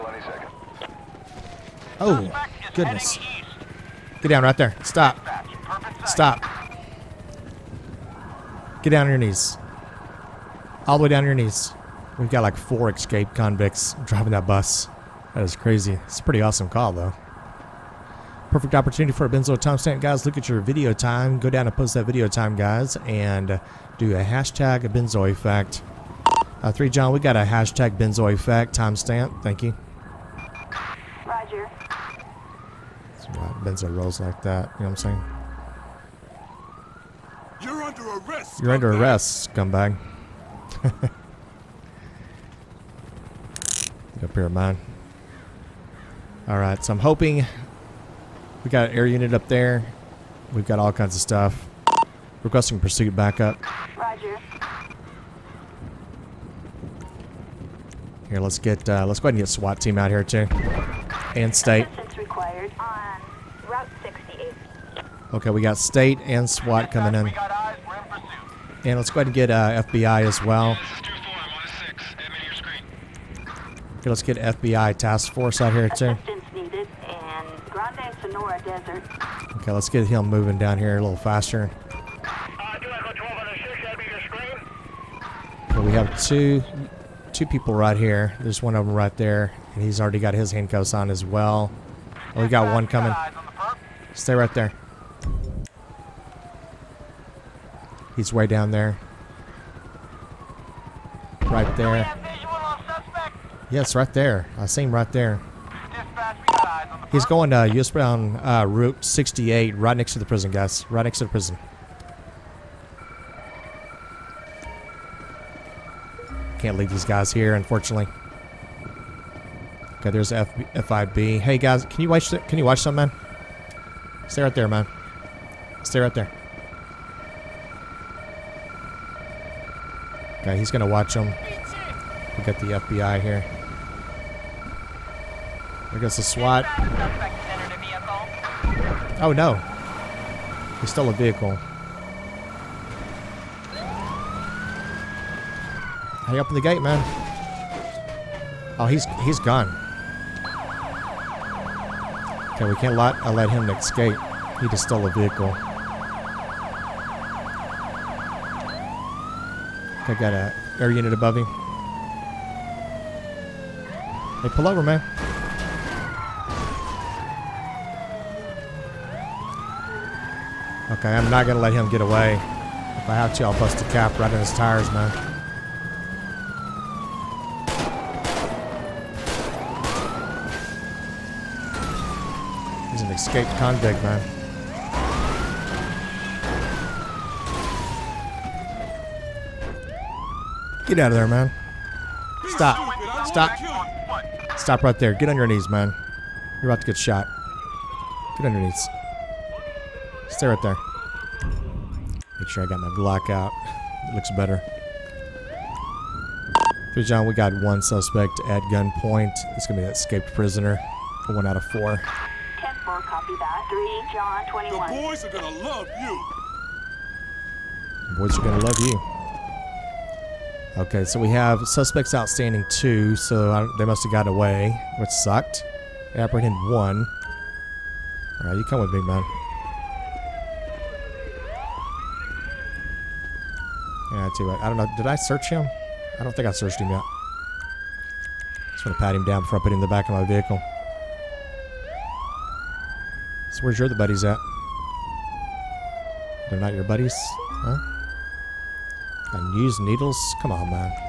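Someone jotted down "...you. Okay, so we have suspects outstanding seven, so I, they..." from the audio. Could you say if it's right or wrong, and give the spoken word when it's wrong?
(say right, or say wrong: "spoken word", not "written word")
wrong: "two", not "seven".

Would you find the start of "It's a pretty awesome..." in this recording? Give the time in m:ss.
0:16.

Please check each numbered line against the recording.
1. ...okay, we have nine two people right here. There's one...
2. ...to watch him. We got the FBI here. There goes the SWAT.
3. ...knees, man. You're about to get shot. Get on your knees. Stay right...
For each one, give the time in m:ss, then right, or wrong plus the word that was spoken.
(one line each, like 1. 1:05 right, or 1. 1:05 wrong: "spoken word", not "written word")
1. 1:25 wrong: "two", not "nine"
2. 2:10 right
3. 3:15 right.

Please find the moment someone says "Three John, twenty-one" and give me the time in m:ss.
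3:33.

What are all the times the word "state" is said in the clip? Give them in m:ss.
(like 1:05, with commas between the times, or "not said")
1:01, 1:05.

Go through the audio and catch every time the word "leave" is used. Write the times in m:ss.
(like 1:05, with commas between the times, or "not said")
1:56.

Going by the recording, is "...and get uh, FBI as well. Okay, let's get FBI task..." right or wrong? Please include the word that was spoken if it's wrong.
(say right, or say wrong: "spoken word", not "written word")
right.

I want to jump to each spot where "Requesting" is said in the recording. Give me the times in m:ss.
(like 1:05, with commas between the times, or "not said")
0:52.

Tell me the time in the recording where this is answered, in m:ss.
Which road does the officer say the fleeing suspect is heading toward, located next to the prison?
1:48.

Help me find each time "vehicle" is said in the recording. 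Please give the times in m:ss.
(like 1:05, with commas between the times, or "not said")
2:21, 2:35, 4:00.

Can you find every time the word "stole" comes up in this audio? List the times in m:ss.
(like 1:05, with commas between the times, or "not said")
2:20, 2:34.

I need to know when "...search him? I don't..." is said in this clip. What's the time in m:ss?
3:55.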